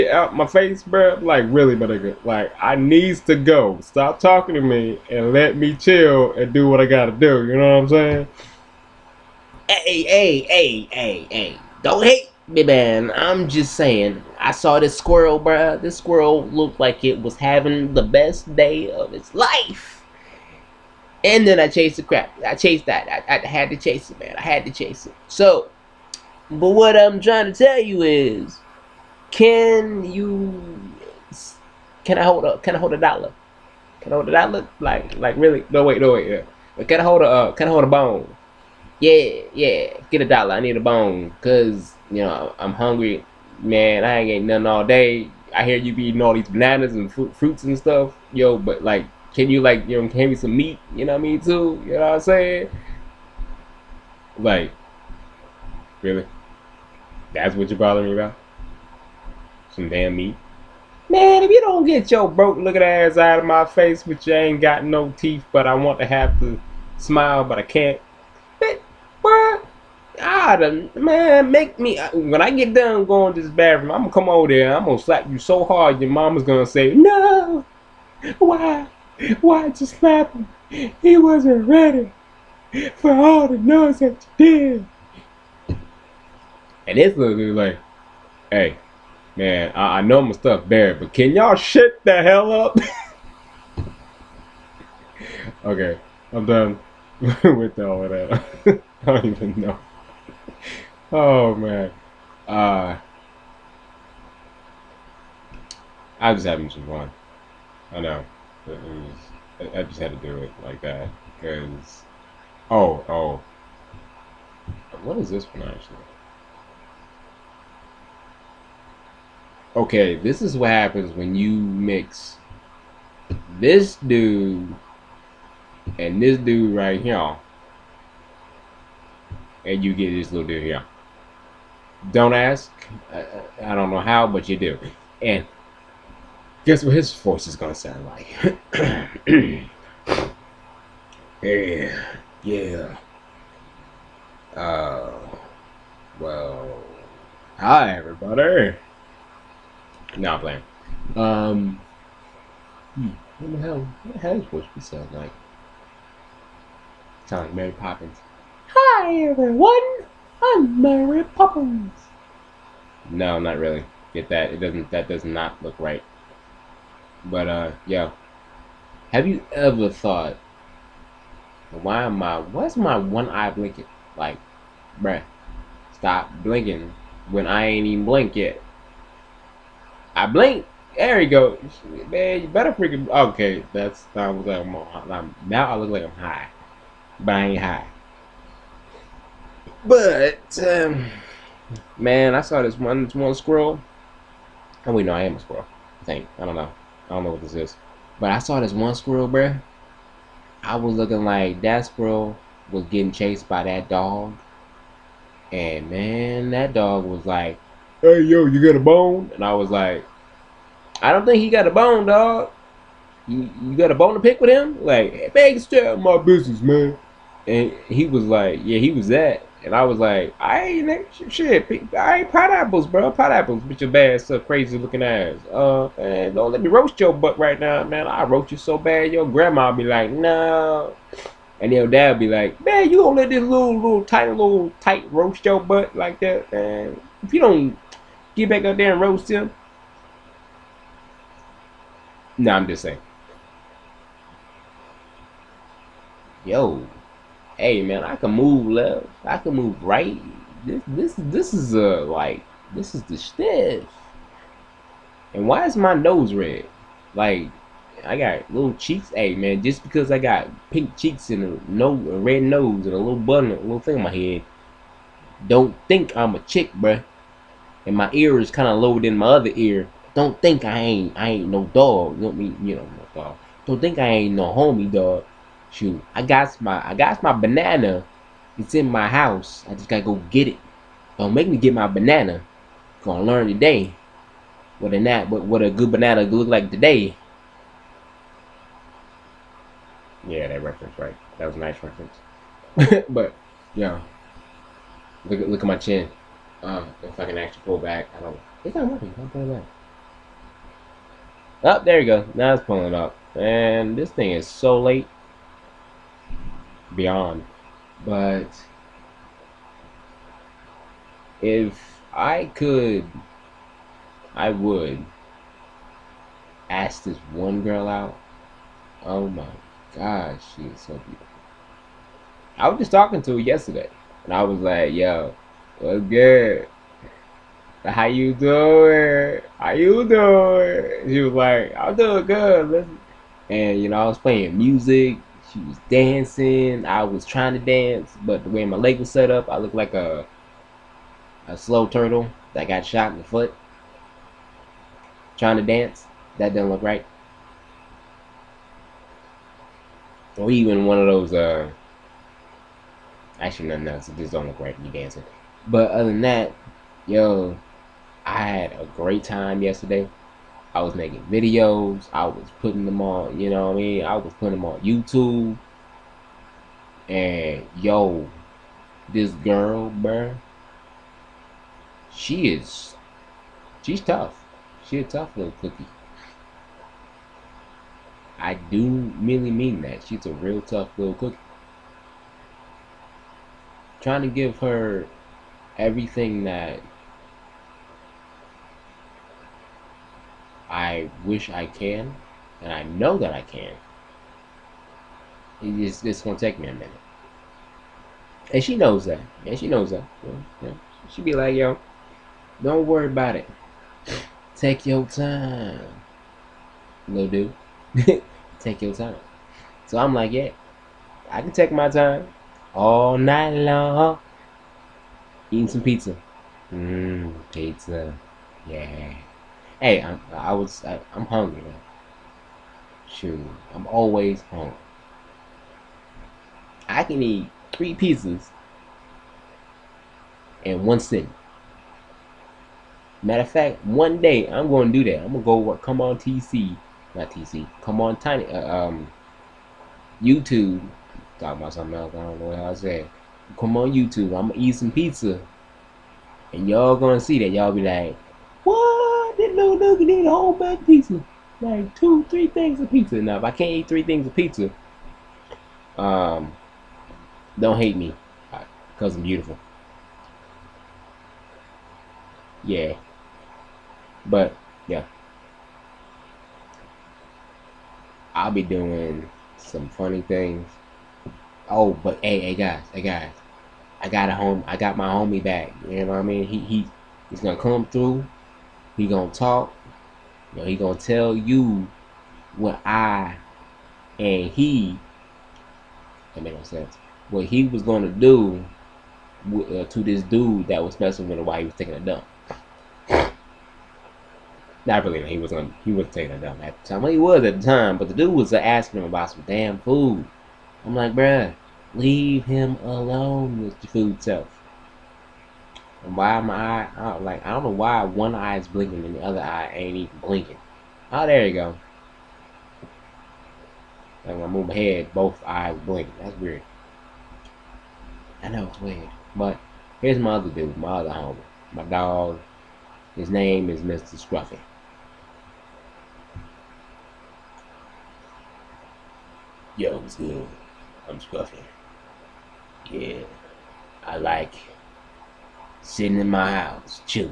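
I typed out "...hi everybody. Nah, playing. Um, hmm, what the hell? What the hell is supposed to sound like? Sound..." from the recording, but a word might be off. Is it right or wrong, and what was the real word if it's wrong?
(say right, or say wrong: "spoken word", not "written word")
right.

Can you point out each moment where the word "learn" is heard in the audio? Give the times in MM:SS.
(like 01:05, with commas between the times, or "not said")
04:43.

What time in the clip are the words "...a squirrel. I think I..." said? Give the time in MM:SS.
03:15.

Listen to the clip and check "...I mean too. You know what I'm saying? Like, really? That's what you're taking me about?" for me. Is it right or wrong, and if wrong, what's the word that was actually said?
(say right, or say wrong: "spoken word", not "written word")
wrong: "bothering", not "taking".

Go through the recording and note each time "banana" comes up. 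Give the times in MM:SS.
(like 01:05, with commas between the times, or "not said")
00:46, 04:37, 04:41, 04:45.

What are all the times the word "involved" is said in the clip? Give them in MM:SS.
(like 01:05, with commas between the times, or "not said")
not said.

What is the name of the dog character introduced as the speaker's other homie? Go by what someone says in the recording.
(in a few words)
Mr. Scruffy.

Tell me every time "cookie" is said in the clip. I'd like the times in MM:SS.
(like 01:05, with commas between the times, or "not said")
06:15, 06:21.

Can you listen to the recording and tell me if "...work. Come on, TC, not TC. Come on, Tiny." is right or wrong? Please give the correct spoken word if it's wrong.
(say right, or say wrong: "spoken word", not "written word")
right.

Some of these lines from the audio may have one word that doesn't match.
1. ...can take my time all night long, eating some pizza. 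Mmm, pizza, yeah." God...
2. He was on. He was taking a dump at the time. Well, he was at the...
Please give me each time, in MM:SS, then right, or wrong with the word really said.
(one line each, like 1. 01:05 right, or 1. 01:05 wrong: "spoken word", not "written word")
1. 06:51 wrong: "Hey", not "God"
2. 08:15 right.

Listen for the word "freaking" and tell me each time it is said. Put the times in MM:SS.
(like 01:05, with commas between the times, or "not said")
03:02.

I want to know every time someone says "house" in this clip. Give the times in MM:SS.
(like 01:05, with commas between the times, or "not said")
04:39, 08:56.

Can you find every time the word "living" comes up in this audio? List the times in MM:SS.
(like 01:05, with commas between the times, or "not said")
not said.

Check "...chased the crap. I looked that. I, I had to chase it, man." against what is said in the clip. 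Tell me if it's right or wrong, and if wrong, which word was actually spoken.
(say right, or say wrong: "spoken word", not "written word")
wrong: "chased", not "looked".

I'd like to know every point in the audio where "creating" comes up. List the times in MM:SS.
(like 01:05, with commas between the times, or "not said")
not said.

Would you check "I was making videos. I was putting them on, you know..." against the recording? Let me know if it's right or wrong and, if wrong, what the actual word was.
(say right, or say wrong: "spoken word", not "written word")
right.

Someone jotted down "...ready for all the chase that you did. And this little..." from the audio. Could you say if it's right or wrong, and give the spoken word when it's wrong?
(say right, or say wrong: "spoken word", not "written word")
wrong: "noise", not "chase".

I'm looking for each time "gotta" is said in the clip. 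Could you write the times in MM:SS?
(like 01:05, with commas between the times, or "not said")
00:06, 04:39.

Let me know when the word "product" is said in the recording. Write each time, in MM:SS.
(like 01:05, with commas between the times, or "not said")
not said.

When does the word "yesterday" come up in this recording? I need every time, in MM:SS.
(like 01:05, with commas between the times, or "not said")
05:23, 05:59.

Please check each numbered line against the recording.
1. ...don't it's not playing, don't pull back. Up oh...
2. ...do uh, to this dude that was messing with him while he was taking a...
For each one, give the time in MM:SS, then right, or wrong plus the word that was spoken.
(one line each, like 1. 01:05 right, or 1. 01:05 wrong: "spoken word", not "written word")
1. 04:58 wrong: "working", not "playing"
2. 08:08 right.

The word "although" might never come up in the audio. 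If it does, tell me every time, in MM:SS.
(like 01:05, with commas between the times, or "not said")
not said.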